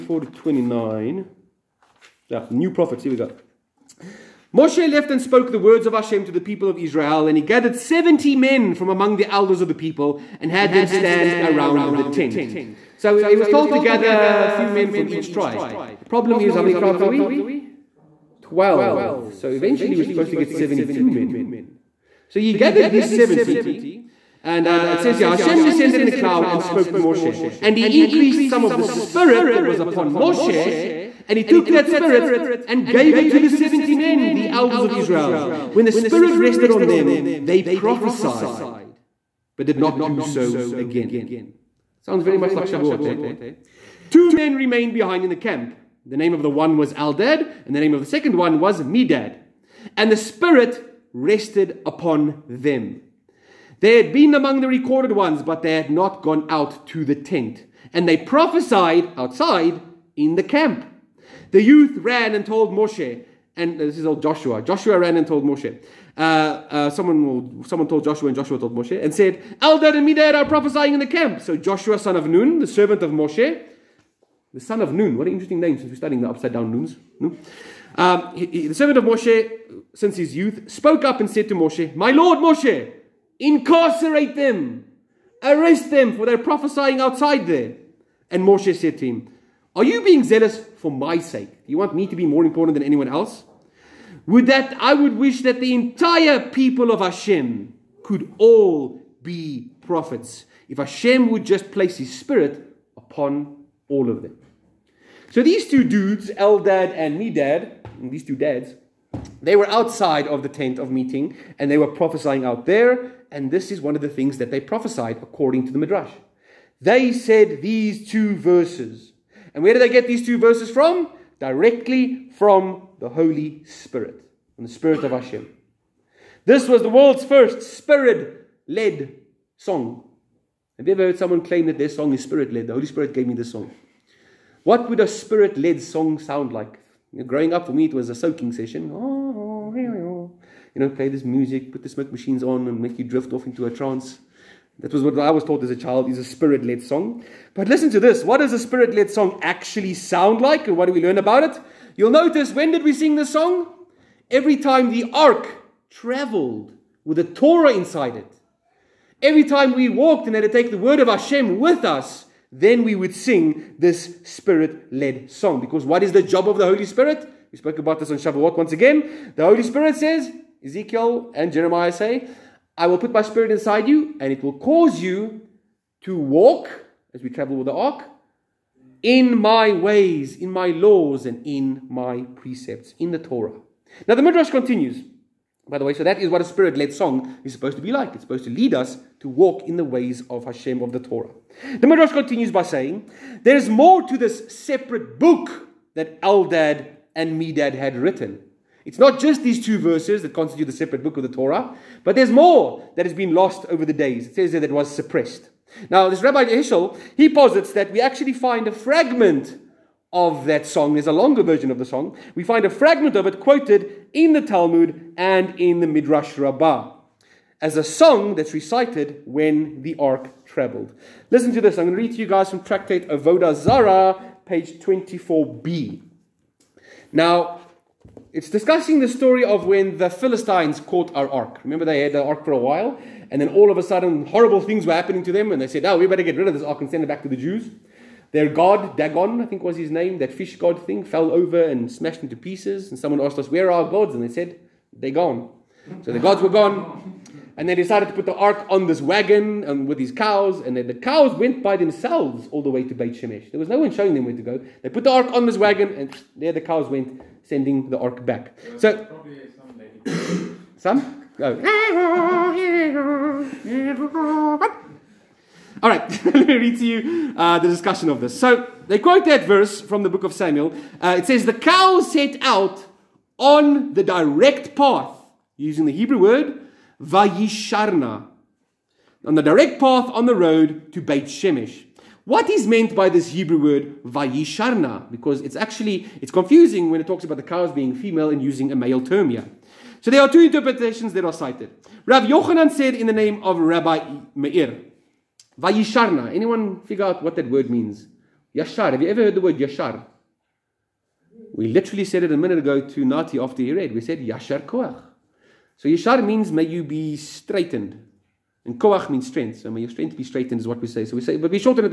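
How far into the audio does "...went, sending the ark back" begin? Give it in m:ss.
4:16.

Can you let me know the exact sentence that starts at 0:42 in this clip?
Sounds very much like Shavuot, eh?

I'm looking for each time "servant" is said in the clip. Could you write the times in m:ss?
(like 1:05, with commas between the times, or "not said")
1:12, 1:18.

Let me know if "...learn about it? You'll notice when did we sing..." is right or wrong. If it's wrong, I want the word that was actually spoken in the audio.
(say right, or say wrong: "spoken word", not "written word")
right.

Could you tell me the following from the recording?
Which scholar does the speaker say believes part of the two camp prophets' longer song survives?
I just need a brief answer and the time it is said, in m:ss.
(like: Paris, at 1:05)
Rabbi Heschel, at 3:26.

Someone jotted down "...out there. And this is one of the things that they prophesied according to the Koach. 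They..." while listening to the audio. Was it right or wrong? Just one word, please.
wrong.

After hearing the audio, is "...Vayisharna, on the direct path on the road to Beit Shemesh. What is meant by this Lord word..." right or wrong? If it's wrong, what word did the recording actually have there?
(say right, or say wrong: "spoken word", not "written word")
wrong: "Hebrew", not "Lord".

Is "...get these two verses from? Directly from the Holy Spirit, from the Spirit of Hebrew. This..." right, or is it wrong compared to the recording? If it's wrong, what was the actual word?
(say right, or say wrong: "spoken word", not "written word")
wrong: "Hashem", not "Hebrew".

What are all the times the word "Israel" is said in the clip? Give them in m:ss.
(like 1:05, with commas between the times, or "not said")
0:06, 0:34.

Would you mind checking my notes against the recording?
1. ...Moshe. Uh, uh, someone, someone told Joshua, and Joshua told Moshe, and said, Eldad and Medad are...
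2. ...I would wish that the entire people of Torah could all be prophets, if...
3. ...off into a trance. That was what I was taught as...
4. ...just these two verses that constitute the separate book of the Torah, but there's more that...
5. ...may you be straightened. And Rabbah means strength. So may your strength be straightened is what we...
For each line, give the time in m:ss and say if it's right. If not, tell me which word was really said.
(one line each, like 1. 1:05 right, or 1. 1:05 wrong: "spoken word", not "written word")
1. 1:05 right
2. 1:34 wrong: "Hashem", not "Torah"
3. 2:23 right
4. 3:19 right
5. 5:06 wrong: "Koach", not "Rabbah".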